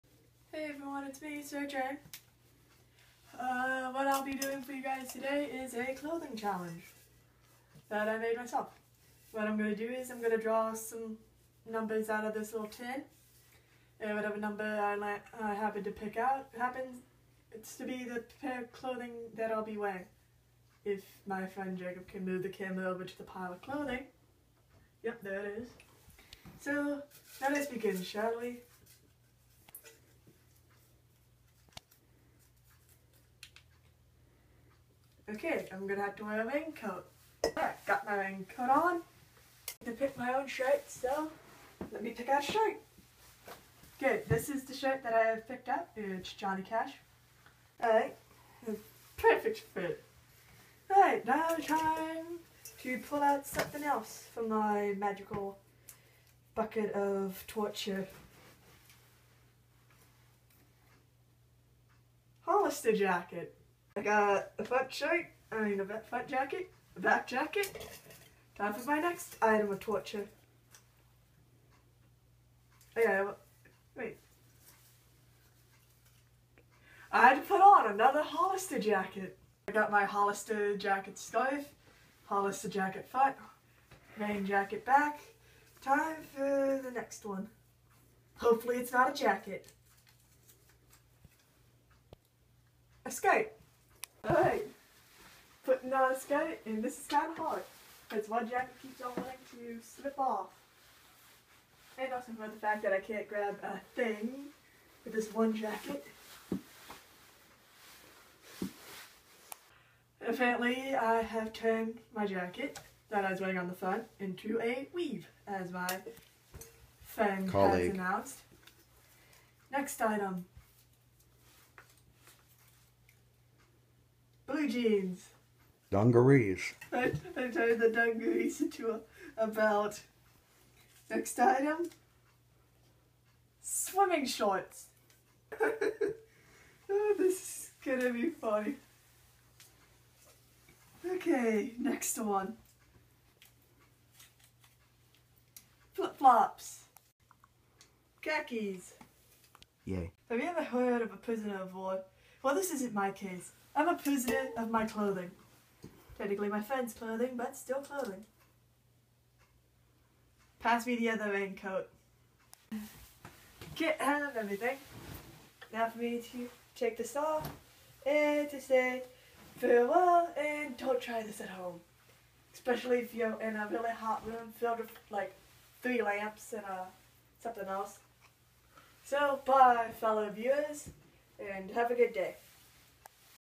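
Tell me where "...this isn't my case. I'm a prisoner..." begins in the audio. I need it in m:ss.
2:32.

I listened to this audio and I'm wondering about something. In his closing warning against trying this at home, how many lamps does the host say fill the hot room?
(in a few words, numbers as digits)
3.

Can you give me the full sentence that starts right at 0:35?
Okay, I'm gonna have to wear a raincoat.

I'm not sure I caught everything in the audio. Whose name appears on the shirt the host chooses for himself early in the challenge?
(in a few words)
Johnny Cash.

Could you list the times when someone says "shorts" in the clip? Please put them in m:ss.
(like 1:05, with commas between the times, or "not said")
2:14.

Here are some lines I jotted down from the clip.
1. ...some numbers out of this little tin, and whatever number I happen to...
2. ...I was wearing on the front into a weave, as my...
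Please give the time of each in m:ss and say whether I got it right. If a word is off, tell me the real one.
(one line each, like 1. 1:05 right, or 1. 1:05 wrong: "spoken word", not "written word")
1. 0:10 right
2. 1:53 right.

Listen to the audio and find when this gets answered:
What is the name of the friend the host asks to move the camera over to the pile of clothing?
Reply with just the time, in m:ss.
0:21.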